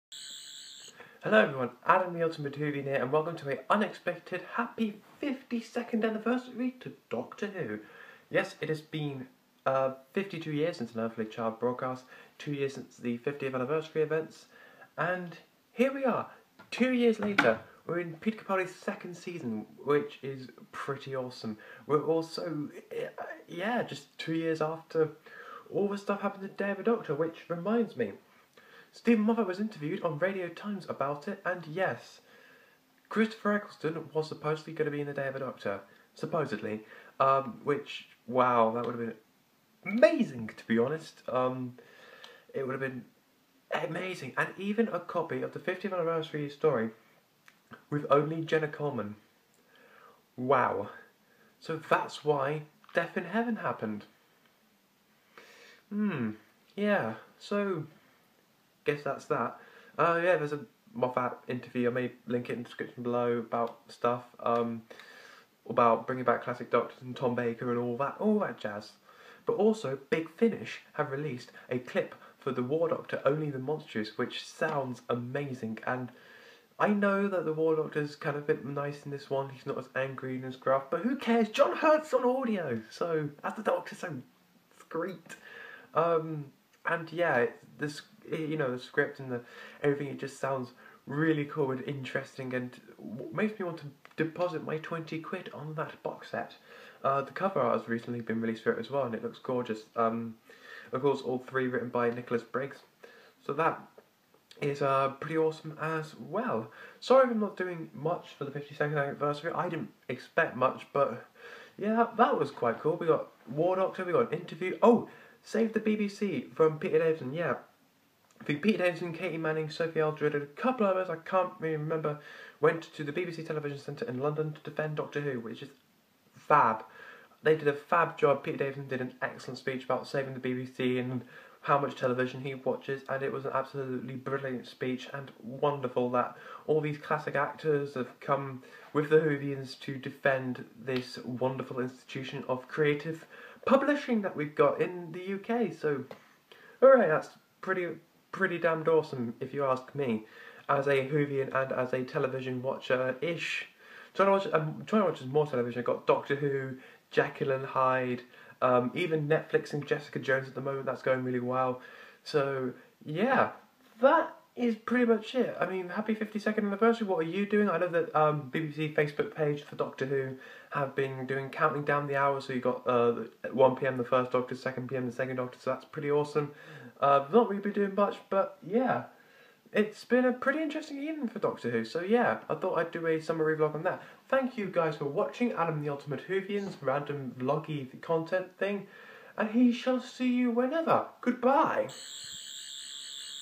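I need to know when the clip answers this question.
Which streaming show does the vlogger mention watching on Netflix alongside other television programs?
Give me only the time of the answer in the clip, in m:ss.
2:39.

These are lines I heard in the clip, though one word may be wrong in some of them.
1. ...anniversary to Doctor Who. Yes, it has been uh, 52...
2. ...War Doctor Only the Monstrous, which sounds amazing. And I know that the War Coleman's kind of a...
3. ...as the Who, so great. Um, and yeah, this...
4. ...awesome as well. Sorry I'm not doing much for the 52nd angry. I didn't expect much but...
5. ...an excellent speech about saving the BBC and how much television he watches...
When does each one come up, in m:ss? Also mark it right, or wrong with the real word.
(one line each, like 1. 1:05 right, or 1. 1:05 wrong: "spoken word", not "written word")
1. 0:06 right
2. 1:12 wrong: "Doctor", not "Coleman"
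3. 1:23 wrong: "Doctor", not "Who"
4. 1:45 wrong: "anniversary", not "angry"
5. 2:09 right.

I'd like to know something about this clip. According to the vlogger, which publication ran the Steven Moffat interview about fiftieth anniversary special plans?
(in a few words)
Radio Times.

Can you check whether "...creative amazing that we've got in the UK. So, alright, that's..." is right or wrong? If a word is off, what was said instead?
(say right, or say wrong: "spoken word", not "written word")
wrong: "publishing", not "amazing".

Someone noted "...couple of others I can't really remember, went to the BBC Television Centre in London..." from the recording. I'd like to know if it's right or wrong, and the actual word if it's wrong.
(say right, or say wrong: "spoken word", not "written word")
right.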